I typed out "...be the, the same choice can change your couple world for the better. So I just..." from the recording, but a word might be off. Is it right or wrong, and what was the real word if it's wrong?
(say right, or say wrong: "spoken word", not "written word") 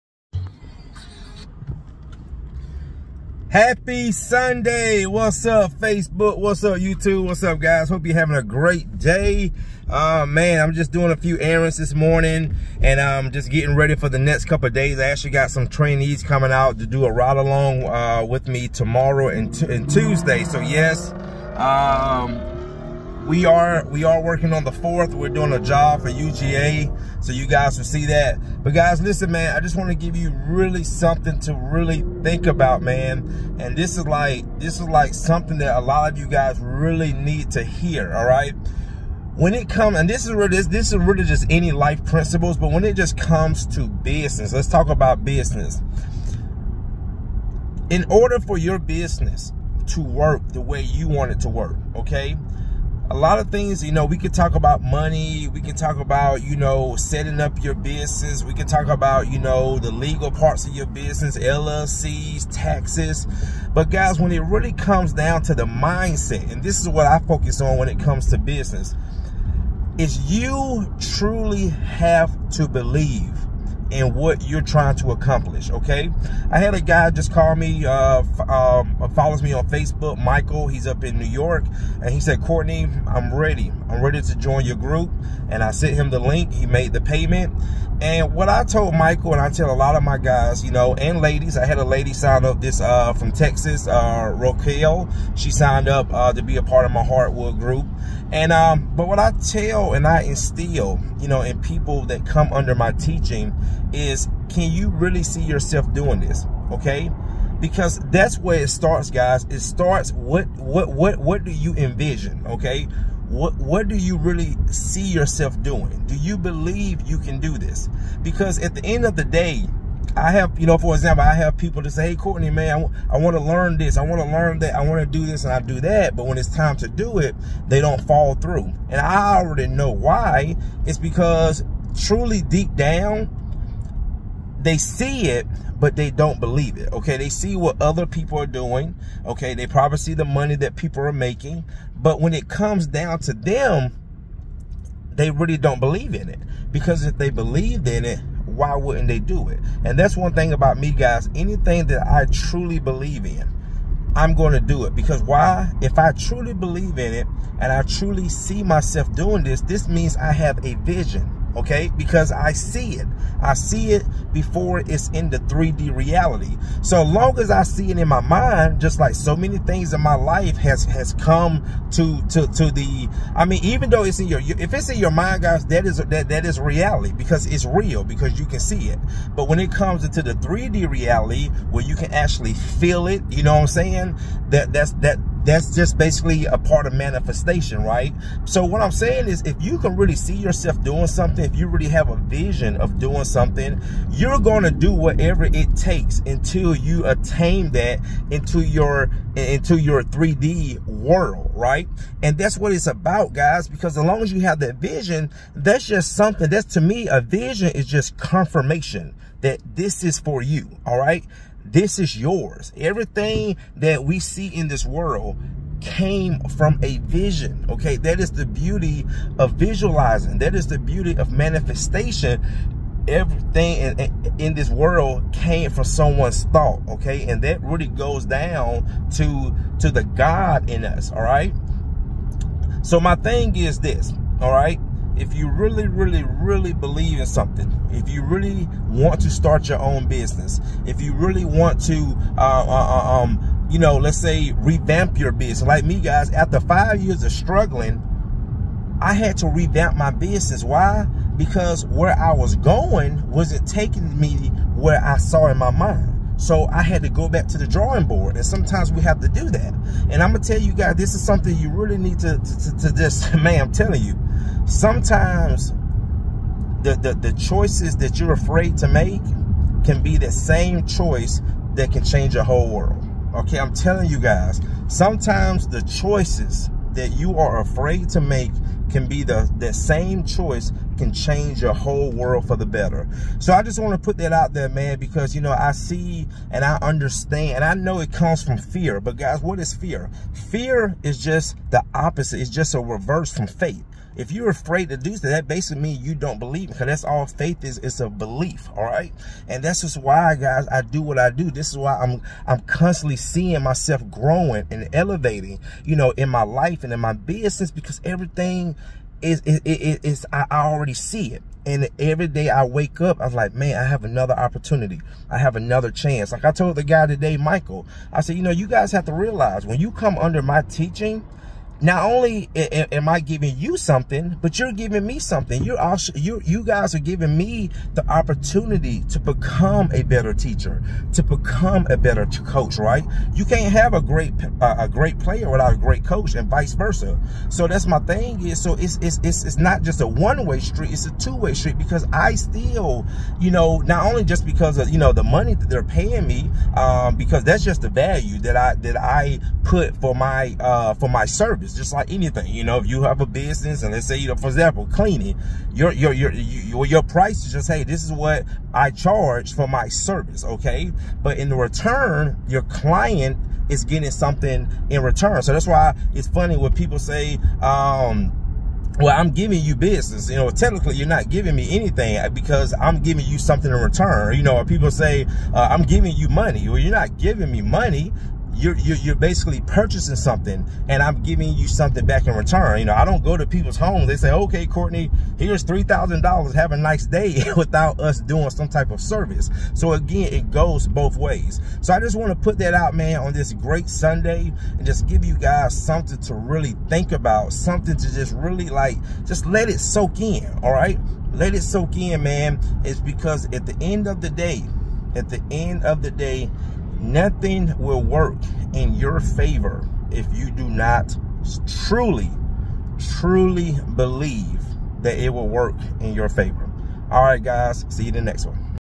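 wrong: "whole", not "couple".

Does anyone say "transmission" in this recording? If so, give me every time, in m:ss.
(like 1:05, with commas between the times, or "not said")
not said.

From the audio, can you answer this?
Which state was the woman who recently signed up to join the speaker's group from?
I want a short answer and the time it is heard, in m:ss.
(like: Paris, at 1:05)
Texas, at 1:33.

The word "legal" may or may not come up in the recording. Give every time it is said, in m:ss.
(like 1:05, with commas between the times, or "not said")
0:59.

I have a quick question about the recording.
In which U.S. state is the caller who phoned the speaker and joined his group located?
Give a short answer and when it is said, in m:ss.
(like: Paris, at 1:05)
New York, at 1:21.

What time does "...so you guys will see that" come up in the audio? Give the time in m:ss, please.
0:27.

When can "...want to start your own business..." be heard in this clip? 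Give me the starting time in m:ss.
3:58.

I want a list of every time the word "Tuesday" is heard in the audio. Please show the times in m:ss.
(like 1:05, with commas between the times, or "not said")
0:19.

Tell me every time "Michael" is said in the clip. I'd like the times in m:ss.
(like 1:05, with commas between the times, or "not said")
1:20, 1:28, 5:17.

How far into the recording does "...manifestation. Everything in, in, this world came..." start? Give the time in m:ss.
3:41.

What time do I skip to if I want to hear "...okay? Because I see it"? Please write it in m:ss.
2:41.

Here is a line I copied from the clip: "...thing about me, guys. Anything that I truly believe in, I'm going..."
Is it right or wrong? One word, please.
right.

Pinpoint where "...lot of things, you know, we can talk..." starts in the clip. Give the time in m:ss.
0:53.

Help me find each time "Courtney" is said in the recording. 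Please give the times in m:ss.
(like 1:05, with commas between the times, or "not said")
1:22, 2:02, 6:24.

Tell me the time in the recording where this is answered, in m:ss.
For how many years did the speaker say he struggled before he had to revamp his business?
4:06.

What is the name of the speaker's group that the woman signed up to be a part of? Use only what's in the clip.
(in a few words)
Hardwood group.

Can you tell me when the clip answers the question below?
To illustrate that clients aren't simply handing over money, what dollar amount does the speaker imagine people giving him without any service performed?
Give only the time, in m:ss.
6:25.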